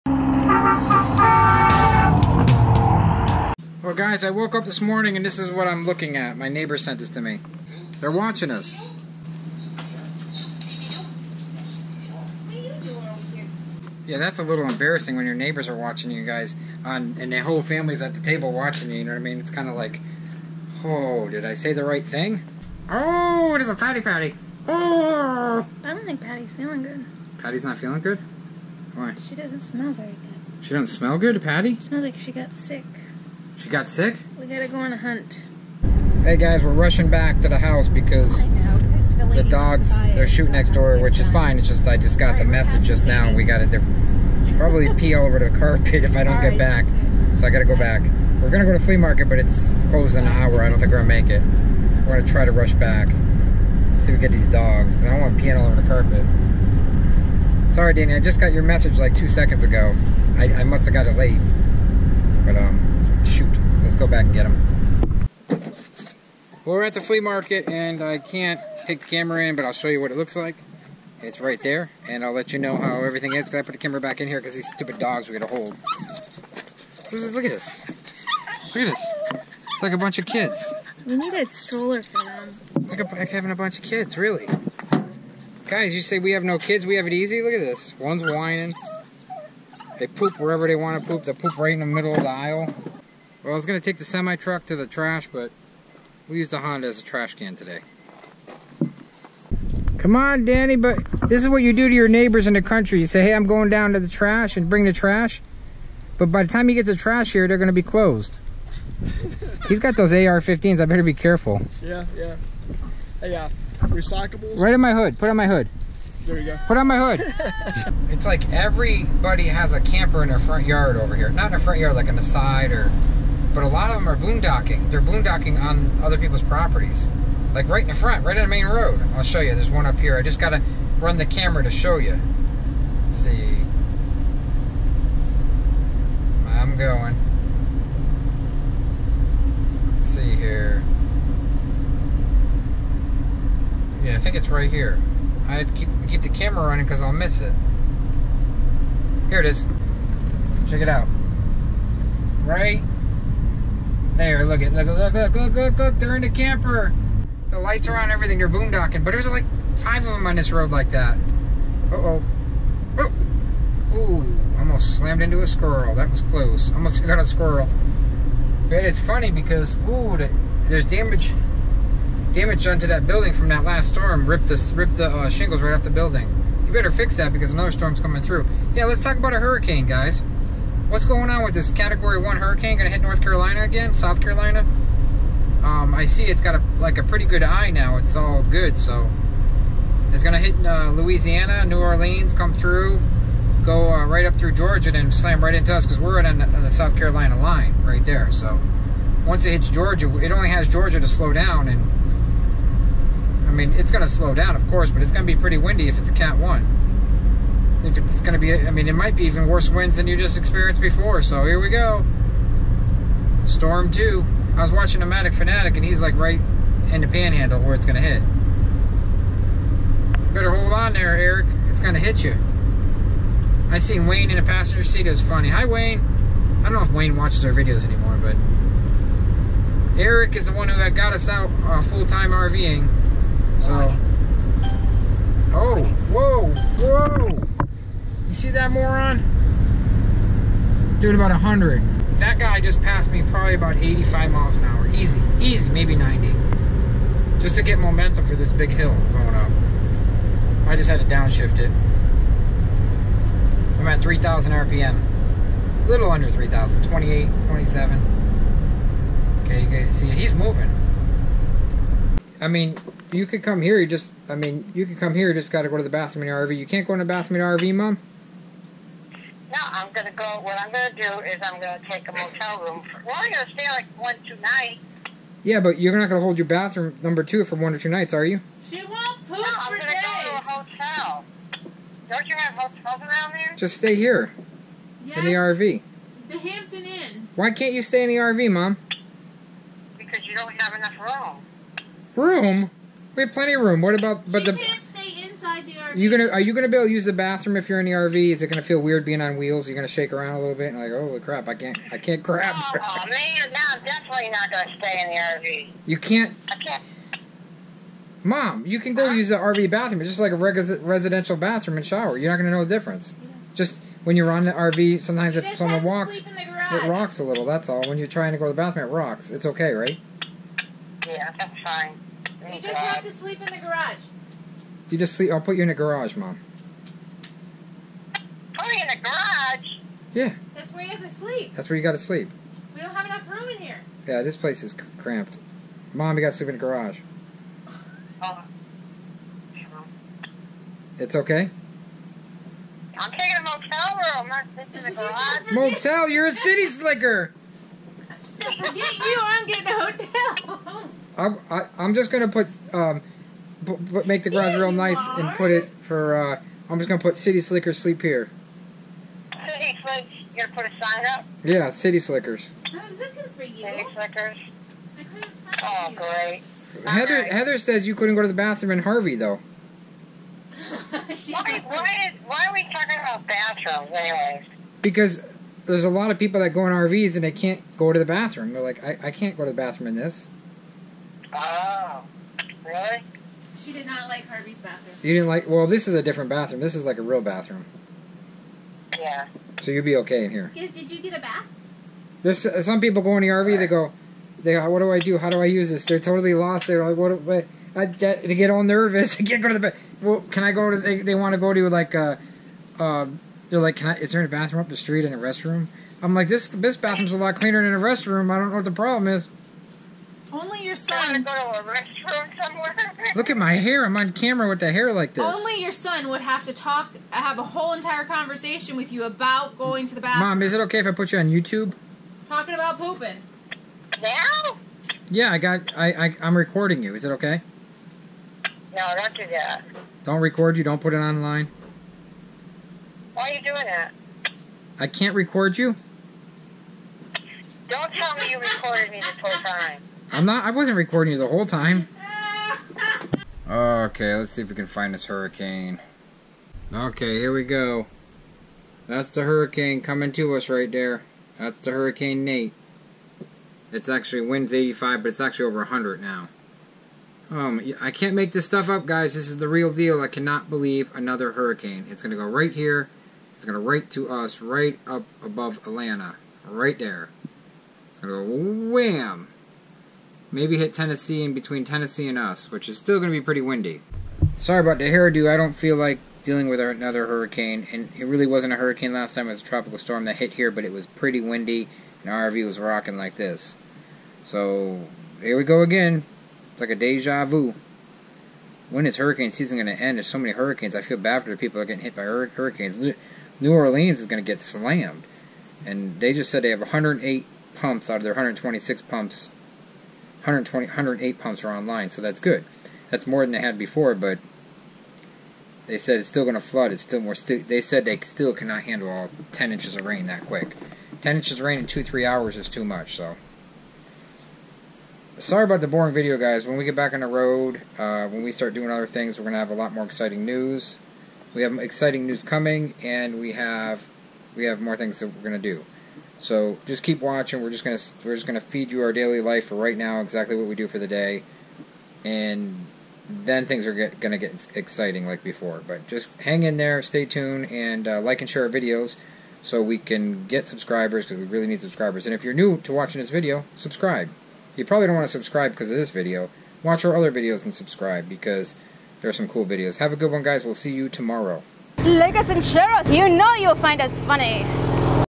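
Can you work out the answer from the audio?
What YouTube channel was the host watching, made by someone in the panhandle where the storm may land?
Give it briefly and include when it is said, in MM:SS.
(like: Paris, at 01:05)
Nomadic Fanatic, at 03:34.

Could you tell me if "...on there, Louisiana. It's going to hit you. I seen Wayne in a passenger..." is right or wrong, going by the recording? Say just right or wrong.
wrong.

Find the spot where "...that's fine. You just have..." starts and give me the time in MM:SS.
05:21.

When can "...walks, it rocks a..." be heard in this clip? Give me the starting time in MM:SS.
05:15.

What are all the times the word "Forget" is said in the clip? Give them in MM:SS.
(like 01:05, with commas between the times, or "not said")
05:48.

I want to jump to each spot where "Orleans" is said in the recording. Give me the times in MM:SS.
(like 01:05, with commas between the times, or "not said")
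03:11, 08:13.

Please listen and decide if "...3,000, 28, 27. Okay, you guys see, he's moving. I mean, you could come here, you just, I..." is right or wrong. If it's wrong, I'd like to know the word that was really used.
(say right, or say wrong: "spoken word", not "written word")
right.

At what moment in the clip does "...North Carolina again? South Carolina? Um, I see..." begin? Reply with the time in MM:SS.
03:03.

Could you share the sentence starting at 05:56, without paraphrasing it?
Uh, I'm just gonna put City Slickers sleep here.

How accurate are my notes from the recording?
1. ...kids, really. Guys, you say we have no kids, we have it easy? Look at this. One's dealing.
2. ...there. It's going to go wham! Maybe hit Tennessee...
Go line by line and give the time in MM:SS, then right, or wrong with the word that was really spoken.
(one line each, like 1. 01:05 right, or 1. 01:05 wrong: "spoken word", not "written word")
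1. 01:23 wrong: "whining", not "dealing"
2. 07:46 right.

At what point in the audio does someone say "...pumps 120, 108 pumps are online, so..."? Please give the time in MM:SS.
08:18.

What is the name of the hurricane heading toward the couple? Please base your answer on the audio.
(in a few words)
Nate.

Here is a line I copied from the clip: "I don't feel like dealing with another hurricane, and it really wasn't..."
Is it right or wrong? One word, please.
right.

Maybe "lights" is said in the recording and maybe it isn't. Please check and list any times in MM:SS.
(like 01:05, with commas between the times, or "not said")
02:37.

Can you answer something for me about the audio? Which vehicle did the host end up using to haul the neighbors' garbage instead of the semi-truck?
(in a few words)
Honda.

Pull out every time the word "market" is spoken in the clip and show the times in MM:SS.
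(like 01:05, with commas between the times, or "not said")
00:48, 01:07.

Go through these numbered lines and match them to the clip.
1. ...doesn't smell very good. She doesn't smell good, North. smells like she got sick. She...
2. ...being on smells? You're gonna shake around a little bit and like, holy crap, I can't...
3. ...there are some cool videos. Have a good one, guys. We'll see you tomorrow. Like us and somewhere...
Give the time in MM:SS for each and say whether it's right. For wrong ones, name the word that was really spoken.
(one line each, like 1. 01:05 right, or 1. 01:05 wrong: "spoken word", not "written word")
1. 00:29 wrong: "Patty", not "North"
2. 04:59 wrong: "wheels", not "smells"
3. 09:09 wrong: "share", not "somewhere".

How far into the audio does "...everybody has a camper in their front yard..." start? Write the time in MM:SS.
01:58.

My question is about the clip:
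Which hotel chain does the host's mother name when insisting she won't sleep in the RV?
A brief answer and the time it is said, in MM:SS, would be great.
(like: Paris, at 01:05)
Hampton Inn, at 04:46.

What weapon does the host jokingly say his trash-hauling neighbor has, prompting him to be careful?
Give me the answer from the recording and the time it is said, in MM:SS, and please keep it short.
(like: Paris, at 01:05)
AR-15s, at 01:50.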